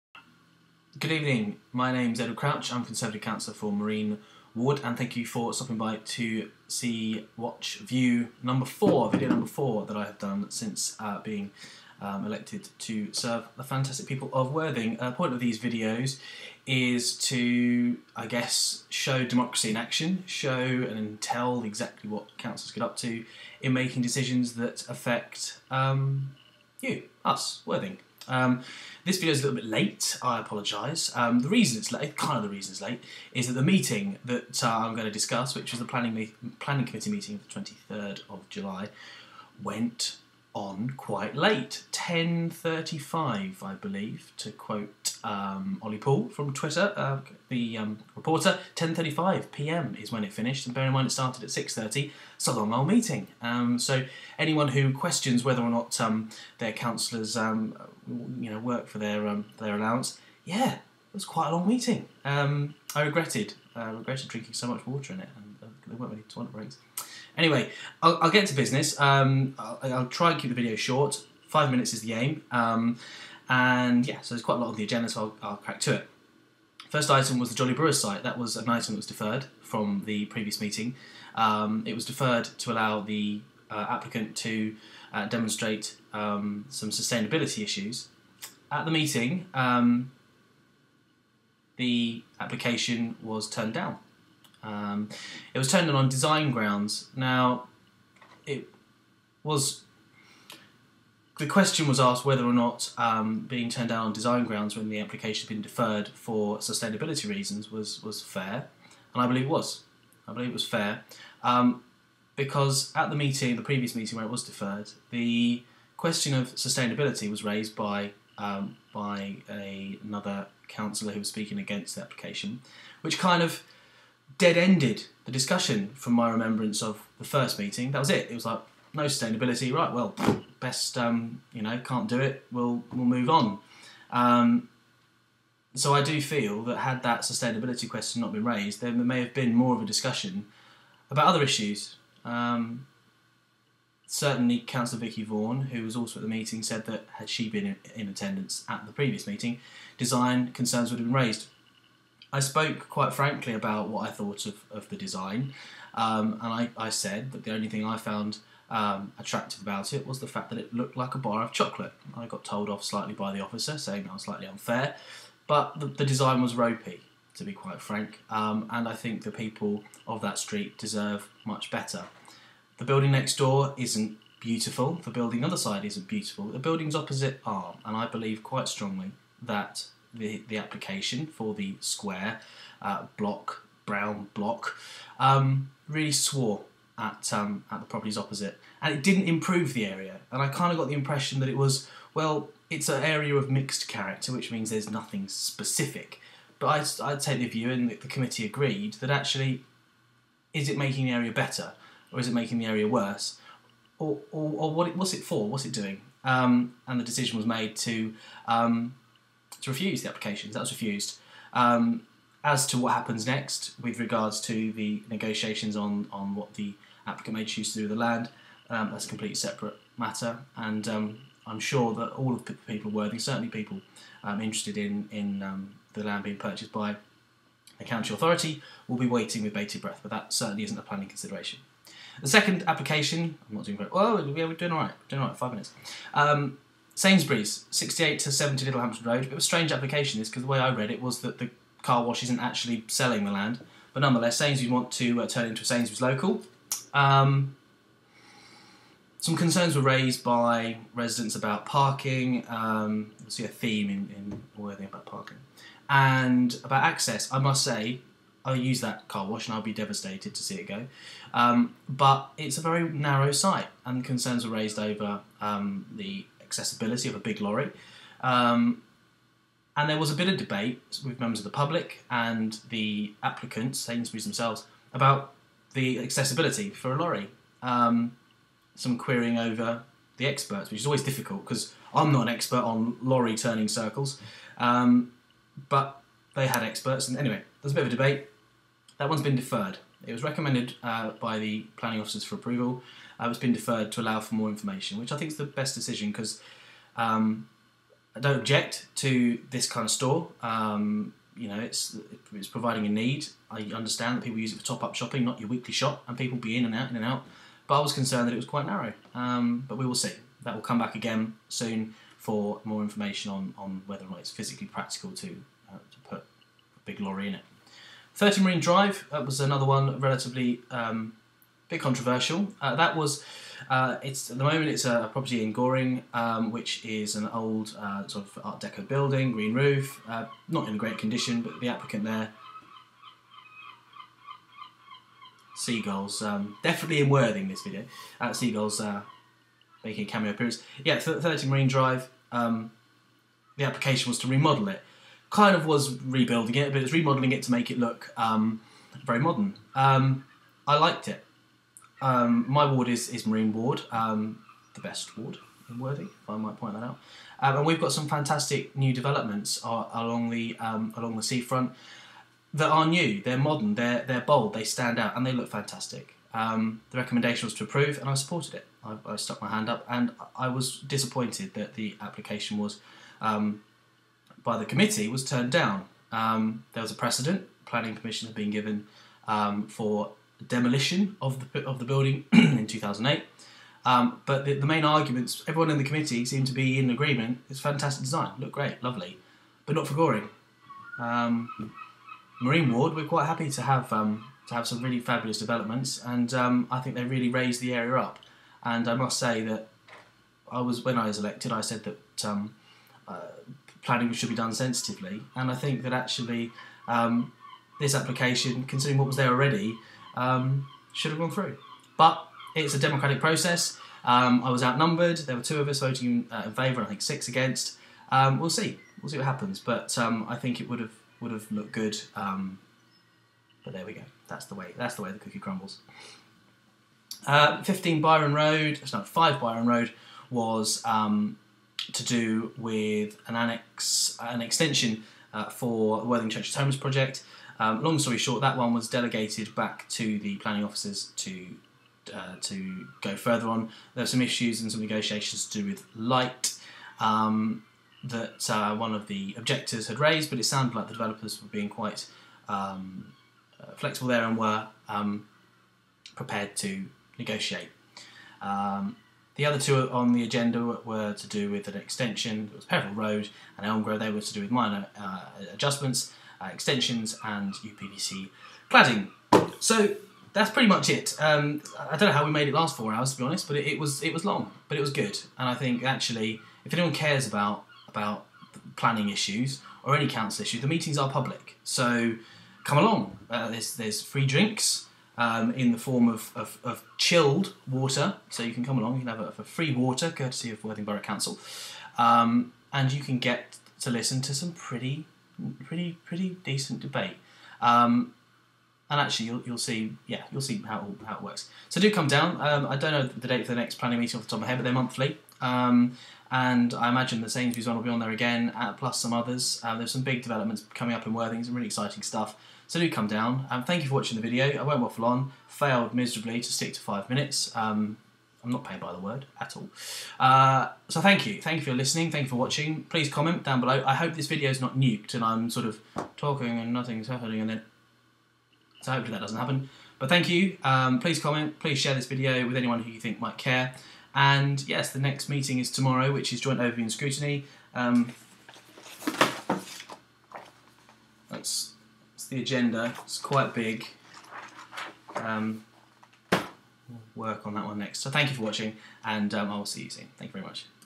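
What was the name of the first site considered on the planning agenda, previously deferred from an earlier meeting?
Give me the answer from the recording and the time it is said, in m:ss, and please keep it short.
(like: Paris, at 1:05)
Jolly Brewers, at 1:17.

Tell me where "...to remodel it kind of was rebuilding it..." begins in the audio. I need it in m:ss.
5:44.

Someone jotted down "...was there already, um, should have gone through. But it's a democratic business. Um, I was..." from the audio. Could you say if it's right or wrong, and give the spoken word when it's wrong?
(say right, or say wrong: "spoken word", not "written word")
wrong: "process", not "business".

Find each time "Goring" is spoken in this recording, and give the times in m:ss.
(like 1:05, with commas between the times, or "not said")
5:25, 6:29.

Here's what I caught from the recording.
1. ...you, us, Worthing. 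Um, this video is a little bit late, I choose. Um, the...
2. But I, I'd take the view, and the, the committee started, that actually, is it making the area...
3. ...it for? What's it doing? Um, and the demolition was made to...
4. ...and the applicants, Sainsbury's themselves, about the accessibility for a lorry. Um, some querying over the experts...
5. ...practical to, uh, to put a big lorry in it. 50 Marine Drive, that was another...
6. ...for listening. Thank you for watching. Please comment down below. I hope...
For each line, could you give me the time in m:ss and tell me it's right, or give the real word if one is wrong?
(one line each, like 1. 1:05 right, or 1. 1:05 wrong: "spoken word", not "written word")
1. 0:26 wrong: "apologise", not "choose"
2. 3:16 wrong: "agreed", not "started"
3. 3:25 wrong: "decision", not "demolition"
4. 4:32 right
5. 5:14 wrong: "30", not "50"
6. 8:41 right.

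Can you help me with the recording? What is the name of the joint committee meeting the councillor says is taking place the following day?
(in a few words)
Joint overview and scrutiny.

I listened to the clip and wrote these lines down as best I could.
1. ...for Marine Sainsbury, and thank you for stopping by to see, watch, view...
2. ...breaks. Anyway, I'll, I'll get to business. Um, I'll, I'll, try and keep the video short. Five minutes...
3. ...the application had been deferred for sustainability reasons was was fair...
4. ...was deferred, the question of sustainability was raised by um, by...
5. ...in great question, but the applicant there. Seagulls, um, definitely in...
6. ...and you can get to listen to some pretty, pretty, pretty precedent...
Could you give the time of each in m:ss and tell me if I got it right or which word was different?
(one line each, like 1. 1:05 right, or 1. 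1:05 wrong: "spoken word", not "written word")
1. 0:03 wrong: "Ward", not "Sainsbury"
2. 1:06 right
3. 1:44 right
4. 1:54 right
5. 5:30 wrong: "condition", not "question"
6. 8:12 wrong: "decent", not "precedent".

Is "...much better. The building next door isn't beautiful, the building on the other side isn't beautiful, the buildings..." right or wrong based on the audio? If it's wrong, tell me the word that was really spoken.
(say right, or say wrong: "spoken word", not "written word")
right.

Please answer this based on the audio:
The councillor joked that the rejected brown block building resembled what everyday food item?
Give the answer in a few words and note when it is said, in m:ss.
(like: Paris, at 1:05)
A bar of chocolate, at 2:41.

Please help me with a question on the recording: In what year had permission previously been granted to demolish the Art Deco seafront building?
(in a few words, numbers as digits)
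2008.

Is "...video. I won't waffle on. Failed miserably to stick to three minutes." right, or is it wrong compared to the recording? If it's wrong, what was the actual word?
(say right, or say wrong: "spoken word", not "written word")
wrong: "five", not "three".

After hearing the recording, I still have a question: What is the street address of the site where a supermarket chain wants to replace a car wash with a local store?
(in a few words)
68 to 70 Littlehampton Road.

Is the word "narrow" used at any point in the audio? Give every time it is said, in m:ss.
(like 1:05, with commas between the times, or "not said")
4:22, 5:08.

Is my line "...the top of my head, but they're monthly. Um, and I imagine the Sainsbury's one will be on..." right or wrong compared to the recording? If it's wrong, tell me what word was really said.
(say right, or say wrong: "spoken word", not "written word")
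right.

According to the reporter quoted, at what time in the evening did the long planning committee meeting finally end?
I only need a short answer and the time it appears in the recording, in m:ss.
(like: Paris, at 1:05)
10.35pm, at 0:48.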